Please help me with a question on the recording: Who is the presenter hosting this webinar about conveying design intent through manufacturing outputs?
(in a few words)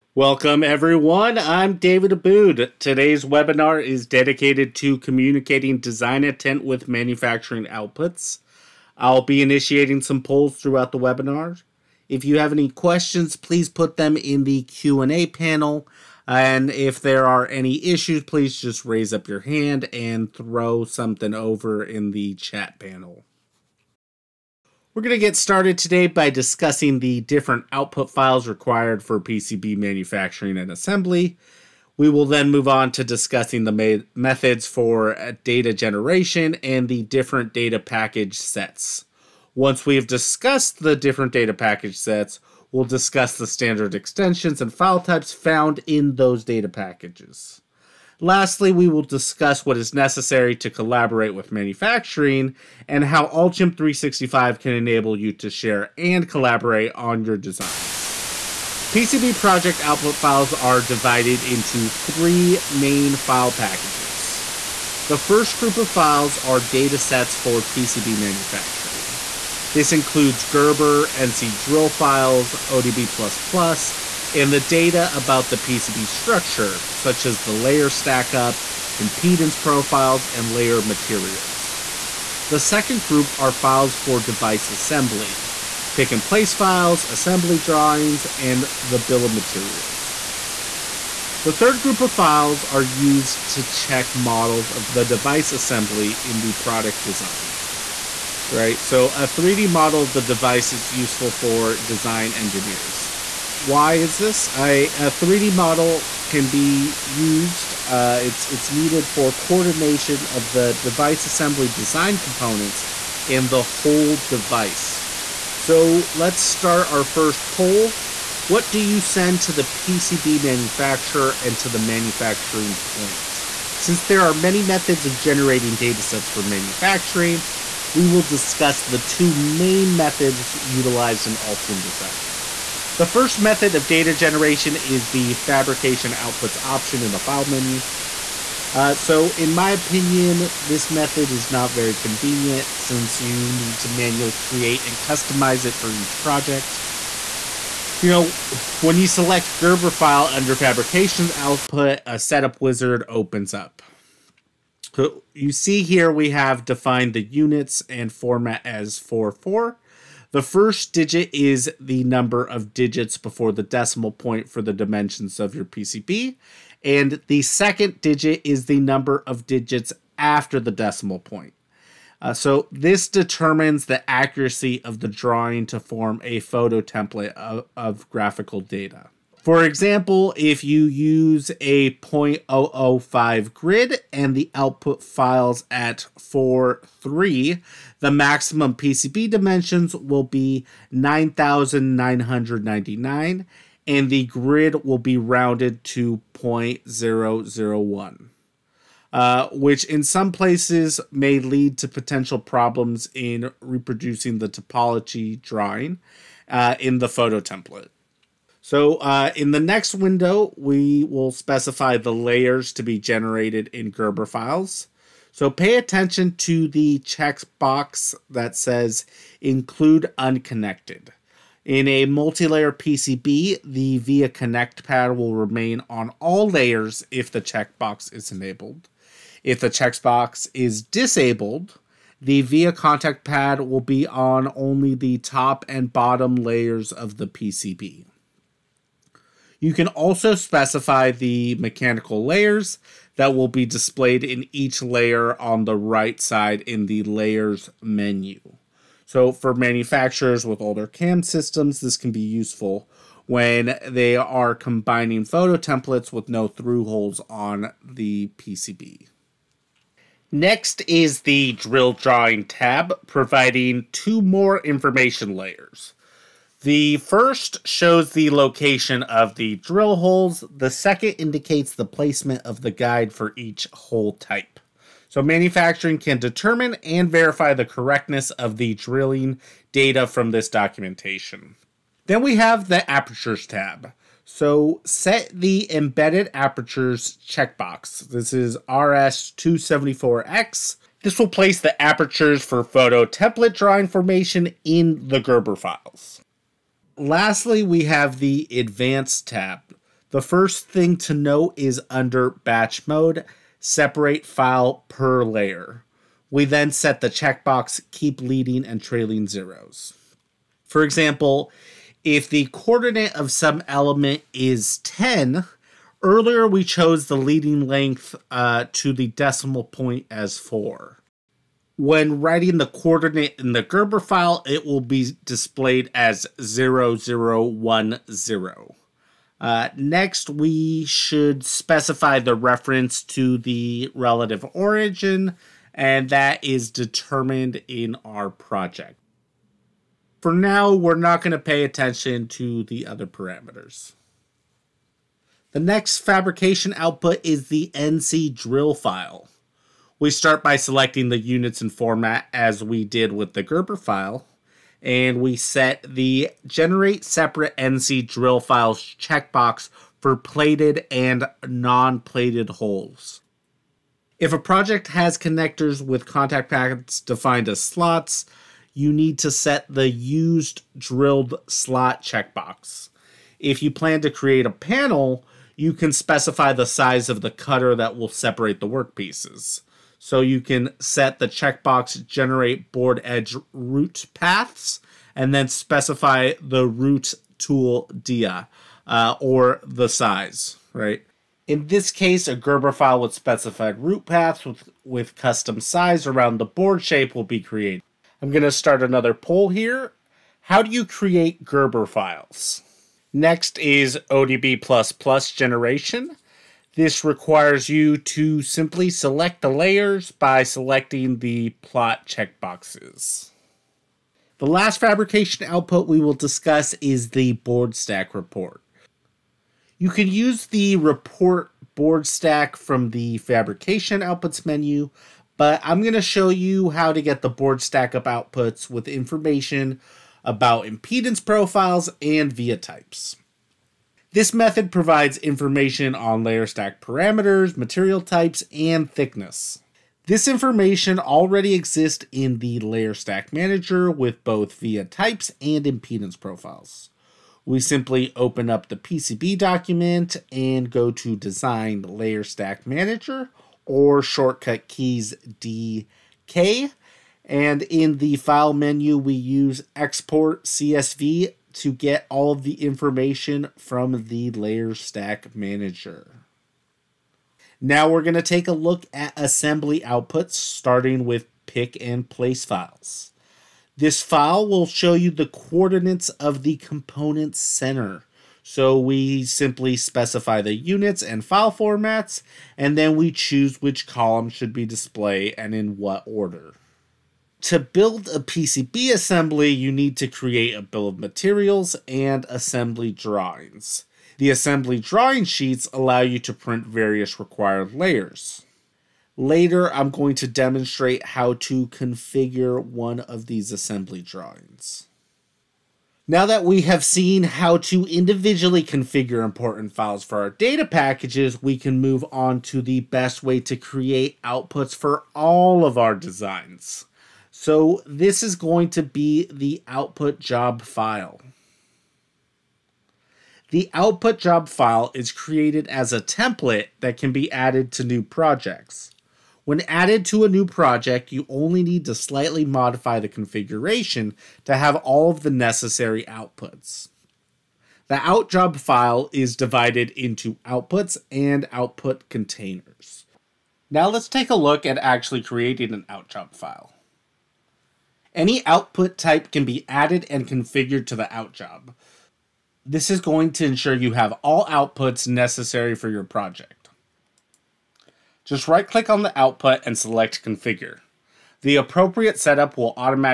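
David Haboud.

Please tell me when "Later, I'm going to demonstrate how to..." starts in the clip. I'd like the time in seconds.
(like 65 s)
499 s.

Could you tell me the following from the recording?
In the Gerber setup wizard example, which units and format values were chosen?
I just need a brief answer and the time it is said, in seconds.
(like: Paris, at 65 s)
4, 4, at 158 s.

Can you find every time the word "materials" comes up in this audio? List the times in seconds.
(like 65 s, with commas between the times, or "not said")
80 s, 89 s, 437 s, 490 s.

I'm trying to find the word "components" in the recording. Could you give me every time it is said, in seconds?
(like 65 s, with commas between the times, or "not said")
112 s, 476 s.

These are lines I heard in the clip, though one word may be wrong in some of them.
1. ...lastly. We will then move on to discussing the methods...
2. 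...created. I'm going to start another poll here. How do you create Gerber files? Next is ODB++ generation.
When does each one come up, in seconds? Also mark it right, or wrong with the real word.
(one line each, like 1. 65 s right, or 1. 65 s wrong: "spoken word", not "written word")
1. 30 s wrong: "assembly", not "lastly"
2. 397 s right.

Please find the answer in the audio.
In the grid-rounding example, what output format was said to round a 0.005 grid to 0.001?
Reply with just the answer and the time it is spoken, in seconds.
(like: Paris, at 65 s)
4, 3, at 186 s.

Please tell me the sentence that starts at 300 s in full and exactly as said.
The first thing to note is under batch mode, separate file per layer.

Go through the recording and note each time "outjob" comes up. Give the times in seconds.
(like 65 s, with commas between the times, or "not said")
537 s, 545 s.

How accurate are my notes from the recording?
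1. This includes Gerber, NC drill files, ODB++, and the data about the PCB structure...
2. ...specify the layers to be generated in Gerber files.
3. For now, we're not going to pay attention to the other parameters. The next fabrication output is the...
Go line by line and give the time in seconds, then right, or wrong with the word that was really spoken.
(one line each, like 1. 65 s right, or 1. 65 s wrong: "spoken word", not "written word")
1. 69 s right
2. 211 s right
3. 340 s right.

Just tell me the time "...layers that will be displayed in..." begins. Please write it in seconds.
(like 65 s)
242 s.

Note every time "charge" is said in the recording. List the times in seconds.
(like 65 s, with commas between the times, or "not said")
not said.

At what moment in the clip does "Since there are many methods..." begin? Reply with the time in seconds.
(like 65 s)
123 s.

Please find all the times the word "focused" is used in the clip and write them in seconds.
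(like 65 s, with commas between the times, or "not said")
not said.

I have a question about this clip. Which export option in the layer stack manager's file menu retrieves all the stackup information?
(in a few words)
export CSV.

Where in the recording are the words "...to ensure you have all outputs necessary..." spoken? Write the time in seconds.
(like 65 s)
553 s.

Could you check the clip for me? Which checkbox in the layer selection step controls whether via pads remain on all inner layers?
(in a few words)
include unconnected.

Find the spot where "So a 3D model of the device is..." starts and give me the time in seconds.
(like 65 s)
98 s.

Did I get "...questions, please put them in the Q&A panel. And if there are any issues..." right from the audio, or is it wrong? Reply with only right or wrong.
right.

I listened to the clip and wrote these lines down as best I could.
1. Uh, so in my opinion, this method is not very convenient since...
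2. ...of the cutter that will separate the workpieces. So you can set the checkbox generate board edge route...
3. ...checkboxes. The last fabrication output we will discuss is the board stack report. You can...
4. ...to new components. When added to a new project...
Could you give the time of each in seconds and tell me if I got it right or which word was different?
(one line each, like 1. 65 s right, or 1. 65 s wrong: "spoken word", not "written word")
1. 138 s right
2. 377 s right
3. 412 s right
4. 527 s wrong: "projects", not "components".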